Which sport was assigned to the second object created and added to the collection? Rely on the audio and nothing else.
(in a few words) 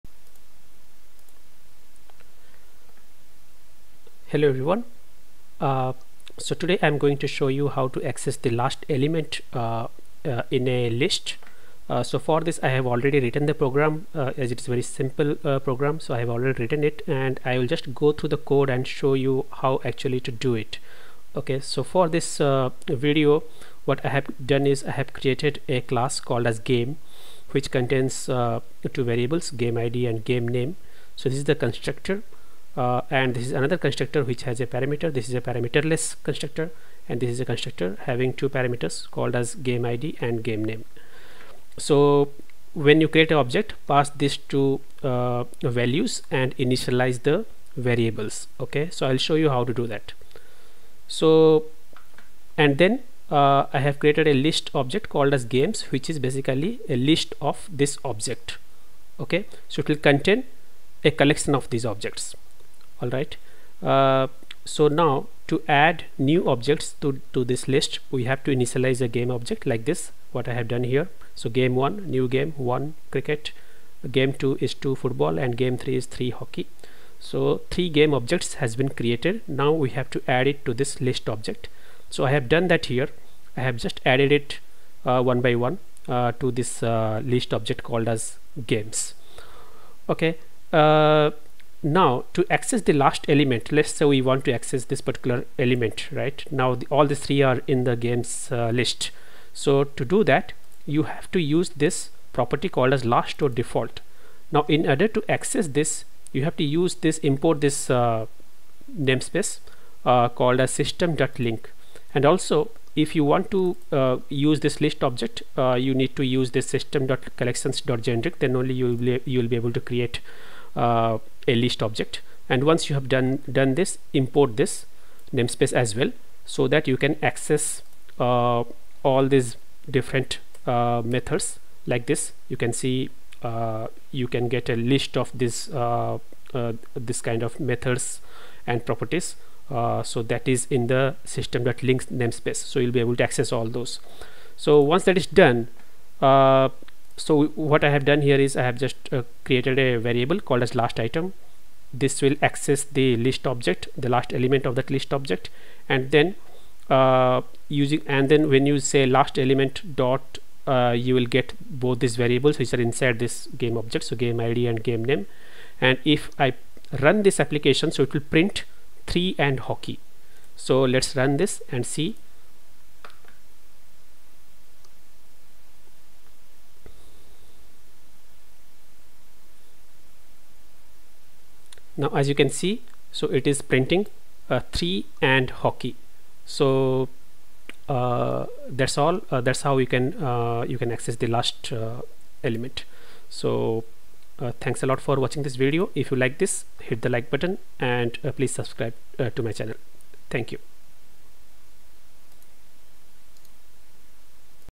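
football.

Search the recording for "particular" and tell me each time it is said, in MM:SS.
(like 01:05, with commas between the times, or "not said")
01:35.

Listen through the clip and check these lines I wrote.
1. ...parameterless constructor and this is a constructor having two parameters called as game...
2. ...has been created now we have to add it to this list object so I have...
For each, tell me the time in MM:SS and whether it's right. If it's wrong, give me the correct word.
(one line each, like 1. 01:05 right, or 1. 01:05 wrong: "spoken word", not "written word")
1. 00:35 right
2. 01:18 right.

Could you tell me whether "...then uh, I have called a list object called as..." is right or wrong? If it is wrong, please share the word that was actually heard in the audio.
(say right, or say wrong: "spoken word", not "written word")
wrong: "created", not "called".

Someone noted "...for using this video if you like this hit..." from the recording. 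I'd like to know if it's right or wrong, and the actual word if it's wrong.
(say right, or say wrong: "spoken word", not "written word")
wrong: "watching", not "using".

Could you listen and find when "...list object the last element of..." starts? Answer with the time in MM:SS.
02:33.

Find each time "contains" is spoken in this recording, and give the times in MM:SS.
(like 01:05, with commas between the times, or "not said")
00:27, 01:00.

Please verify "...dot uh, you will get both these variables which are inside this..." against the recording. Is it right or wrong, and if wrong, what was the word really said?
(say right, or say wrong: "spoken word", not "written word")
right.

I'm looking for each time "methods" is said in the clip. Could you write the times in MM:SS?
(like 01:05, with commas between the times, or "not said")
02:11, 02:17.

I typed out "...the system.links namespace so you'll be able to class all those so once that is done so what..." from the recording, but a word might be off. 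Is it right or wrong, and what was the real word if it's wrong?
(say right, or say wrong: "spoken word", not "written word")
wrong: "access", not "class".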